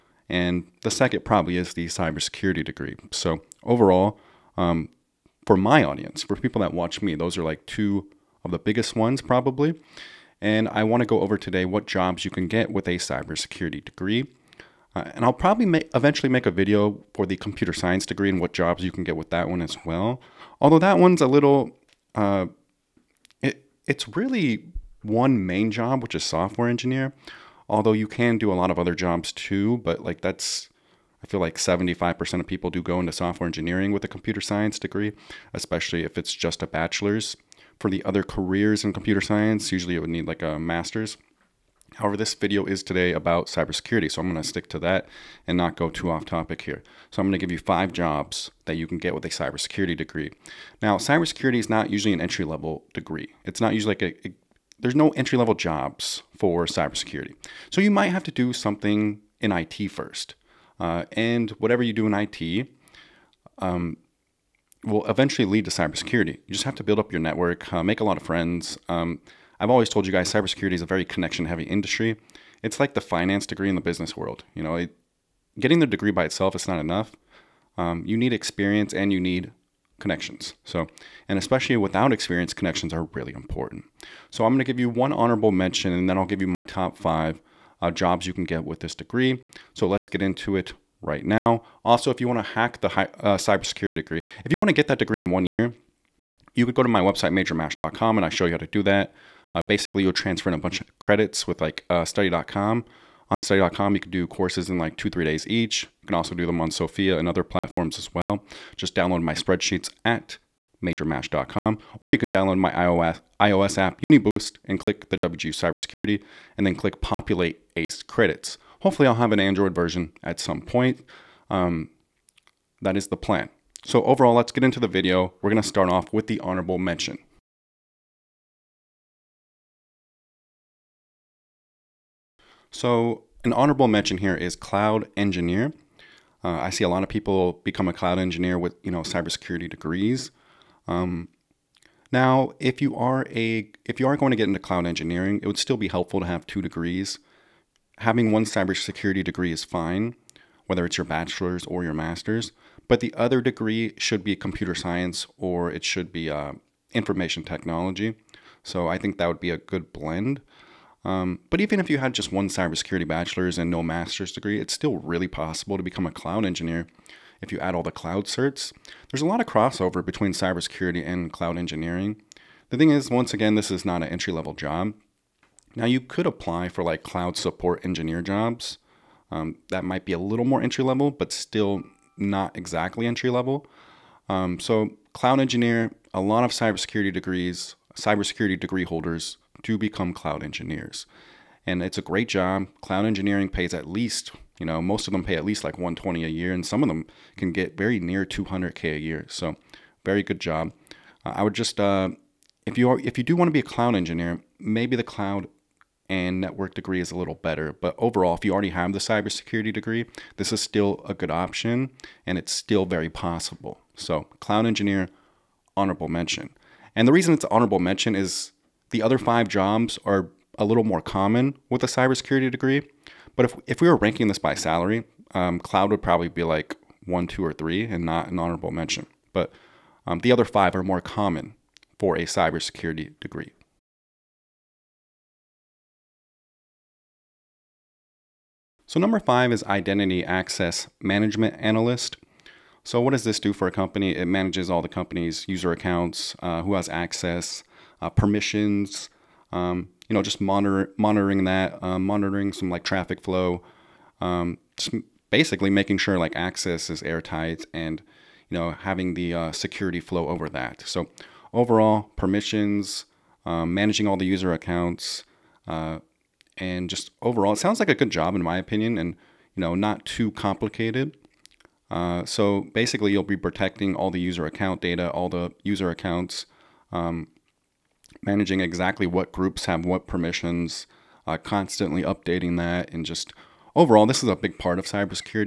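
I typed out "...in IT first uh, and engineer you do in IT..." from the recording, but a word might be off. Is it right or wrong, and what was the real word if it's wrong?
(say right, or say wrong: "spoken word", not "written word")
wrong: "whatever", not "engineer".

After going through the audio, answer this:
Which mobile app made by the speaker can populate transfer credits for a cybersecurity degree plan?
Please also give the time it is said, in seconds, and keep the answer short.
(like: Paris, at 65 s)
UniBoost, at 114 s.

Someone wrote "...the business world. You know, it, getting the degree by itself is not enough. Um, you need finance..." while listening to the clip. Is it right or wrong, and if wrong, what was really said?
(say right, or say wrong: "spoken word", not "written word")
wrong: "experience", not "finance".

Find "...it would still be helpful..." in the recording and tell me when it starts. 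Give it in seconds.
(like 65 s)
145 s.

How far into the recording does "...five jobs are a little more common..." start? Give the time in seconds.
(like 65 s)
219 s.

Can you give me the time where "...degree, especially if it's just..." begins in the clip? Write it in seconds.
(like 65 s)
34 s.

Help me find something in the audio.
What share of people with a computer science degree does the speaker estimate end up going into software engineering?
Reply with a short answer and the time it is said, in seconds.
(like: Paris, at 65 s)
75%, at 31 s.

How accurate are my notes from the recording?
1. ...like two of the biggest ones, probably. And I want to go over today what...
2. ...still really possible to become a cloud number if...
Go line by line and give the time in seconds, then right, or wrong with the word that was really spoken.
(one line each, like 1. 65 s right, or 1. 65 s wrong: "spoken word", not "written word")
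1. 7 s right
2. 164 s wrong: "engineer", not "number".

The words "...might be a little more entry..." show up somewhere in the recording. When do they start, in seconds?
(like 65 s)
179 s.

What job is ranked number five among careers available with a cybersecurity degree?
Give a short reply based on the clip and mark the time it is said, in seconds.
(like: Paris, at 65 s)
Identity Access Management Analyst, at 239 s.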